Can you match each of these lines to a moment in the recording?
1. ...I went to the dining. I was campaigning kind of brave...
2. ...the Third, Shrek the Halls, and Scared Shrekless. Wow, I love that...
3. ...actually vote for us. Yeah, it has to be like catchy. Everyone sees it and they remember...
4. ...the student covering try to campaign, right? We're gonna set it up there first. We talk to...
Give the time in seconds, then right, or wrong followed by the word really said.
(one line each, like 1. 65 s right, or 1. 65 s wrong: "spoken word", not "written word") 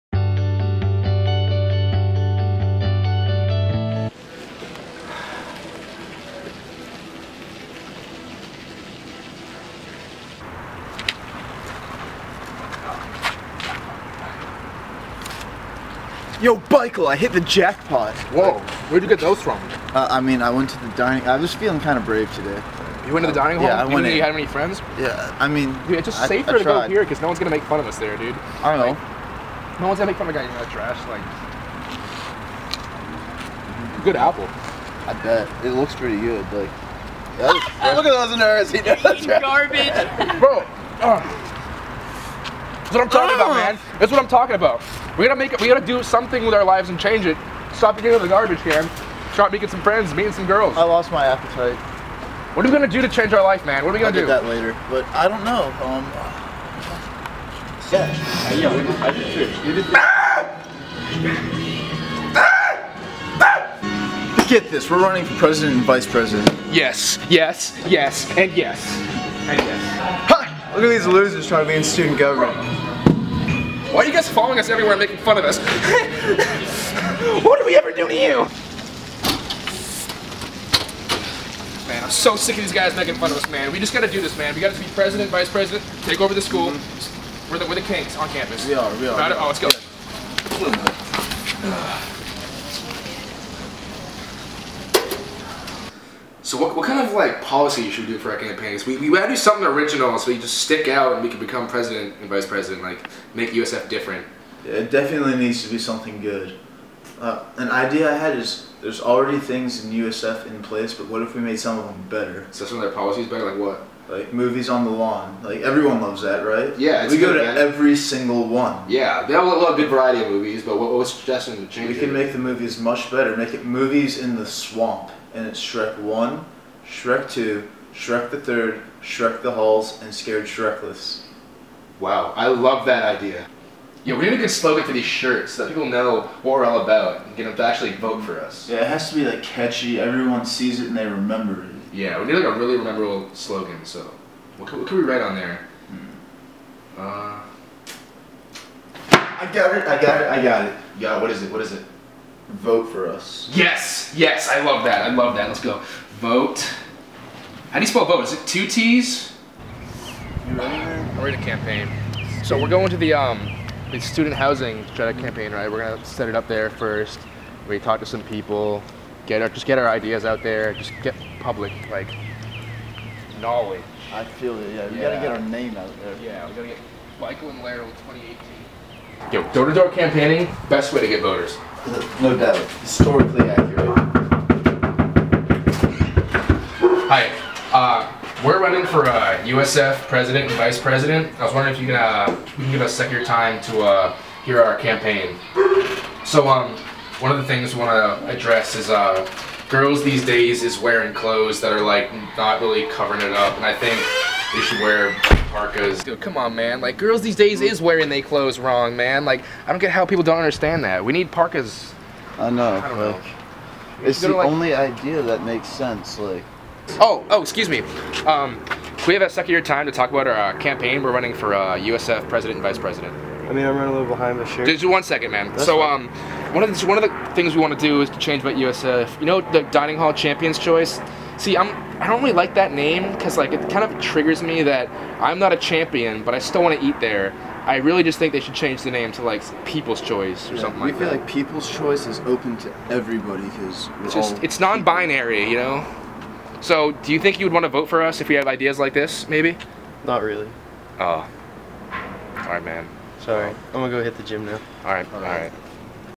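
1. 20 s wrong: "feeling", not "campaigning"
2. 128 s right
3. 137 s right
4. 163 s wrong: "housing", not "covering".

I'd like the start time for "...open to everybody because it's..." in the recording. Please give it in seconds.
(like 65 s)
242 s.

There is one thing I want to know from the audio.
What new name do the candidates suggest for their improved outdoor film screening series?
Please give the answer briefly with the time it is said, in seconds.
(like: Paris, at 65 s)
Movies in the swamp, at 123 s.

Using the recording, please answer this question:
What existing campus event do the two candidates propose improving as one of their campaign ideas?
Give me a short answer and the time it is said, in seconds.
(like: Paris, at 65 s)
Movies on the lawn, at 114 s.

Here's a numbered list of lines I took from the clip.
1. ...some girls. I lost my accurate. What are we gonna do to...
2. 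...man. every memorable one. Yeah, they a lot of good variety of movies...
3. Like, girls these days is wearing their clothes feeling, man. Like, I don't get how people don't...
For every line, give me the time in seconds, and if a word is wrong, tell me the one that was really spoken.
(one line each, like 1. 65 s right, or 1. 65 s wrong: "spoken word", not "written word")
1. 50 s wrong: "appetite", not "accurate"
2. 117 s wrong: "single", not "memorable"
3. 206 s wrong: "wrong", not "feeling".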